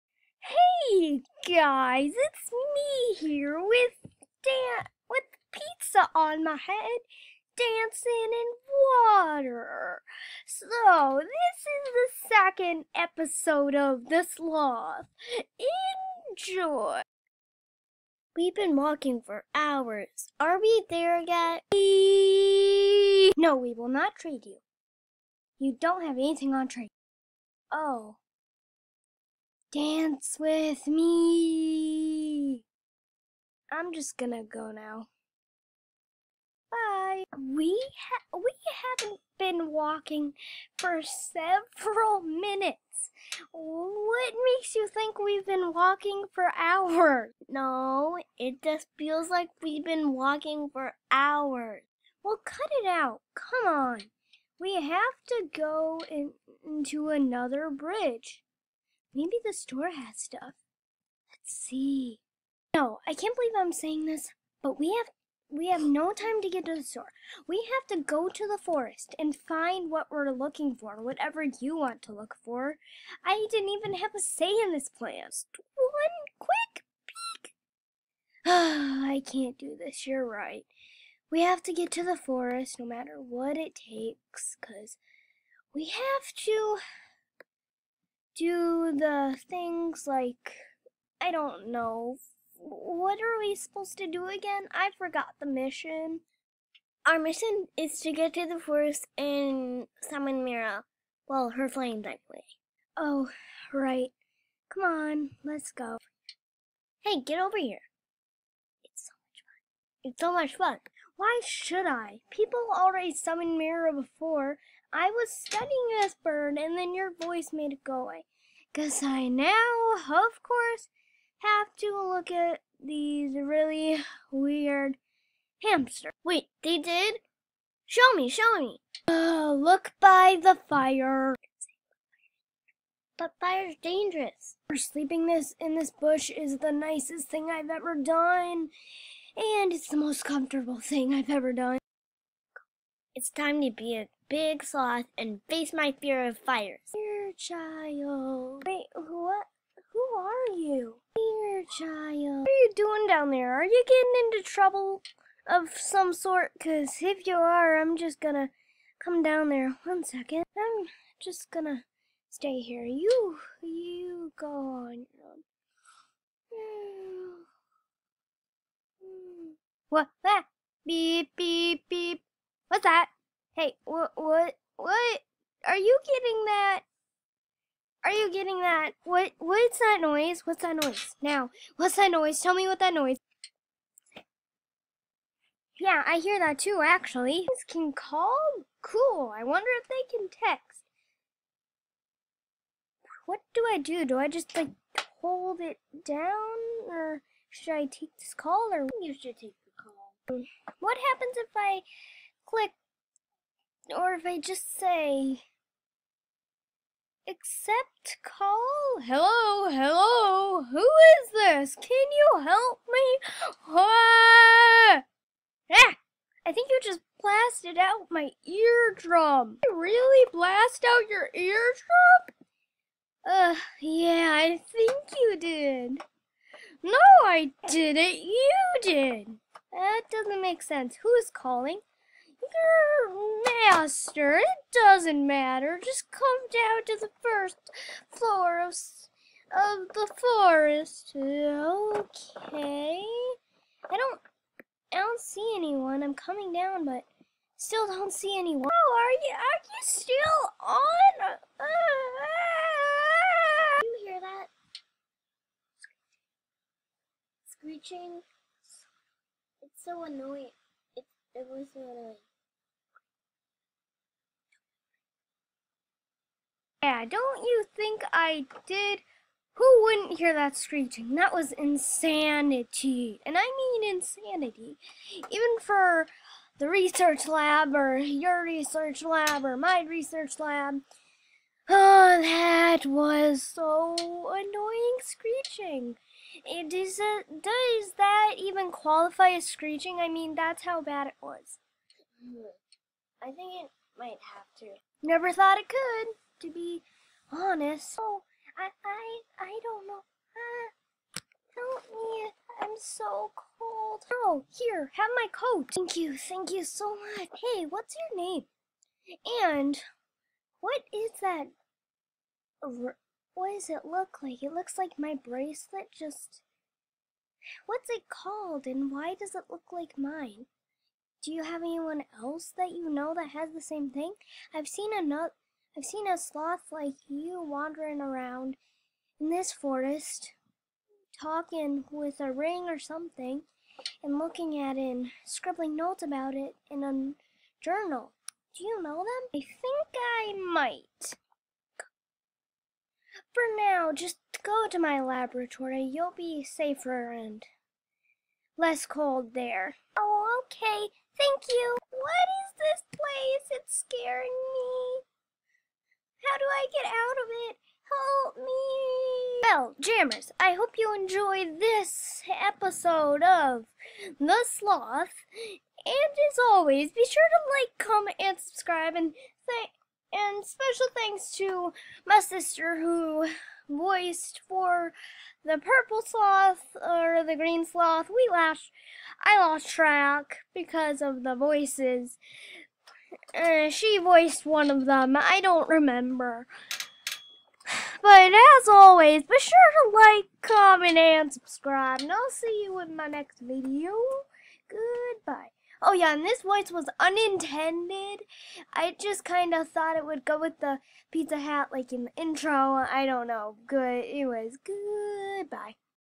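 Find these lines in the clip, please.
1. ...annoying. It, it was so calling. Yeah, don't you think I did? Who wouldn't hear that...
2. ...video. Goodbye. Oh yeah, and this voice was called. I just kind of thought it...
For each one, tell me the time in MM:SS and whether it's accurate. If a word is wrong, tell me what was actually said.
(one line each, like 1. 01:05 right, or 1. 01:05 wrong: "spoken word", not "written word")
1. 04:20 wrong: "annoying", not "calling"
2. 06:33 wrong: "unintended", not "called".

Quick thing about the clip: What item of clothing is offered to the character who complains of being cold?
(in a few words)
Coat.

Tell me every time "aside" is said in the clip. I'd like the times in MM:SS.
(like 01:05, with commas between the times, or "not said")
not said.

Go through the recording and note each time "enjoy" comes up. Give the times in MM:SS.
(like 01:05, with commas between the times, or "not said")
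00:16, 06:00.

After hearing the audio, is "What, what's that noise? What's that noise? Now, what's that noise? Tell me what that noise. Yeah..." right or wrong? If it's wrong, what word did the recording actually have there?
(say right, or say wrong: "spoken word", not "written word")
right.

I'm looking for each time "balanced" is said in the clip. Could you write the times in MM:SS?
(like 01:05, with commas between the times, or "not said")
not said.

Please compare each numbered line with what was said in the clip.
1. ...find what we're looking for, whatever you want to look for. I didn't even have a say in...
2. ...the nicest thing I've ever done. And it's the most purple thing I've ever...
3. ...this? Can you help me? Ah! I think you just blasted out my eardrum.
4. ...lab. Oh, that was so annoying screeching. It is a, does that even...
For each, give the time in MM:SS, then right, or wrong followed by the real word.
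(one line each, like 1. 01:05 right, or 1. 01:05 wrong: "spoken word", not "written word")
1. 01:09 right
2. 02:16 wrong: "comfortable", not "purple"
3. 03:31 right
4. 04:40 right.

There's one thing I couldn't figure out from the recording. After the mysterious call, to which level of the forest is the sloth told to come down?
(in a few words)
The first floor.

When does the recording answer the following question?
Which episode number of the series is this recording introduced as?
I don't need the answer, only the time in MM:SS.
00:12.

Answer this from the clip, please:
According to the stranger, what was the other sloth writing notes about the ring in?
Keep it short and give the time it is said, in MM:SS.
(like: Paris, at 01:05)
A journal, at 05:37.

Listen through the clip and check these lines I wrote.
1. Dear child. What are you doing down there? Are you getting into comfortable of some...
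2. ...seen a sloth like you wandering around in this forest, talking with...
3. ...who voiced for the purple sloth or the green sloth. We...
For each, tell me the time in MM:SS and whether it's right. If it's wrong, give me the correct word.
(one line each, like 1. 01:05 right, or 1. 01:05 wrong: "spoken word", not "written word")
1. 02:31 wrong: "trouble", not "comfortable"
2. 05:25 right
3. 06:12 right.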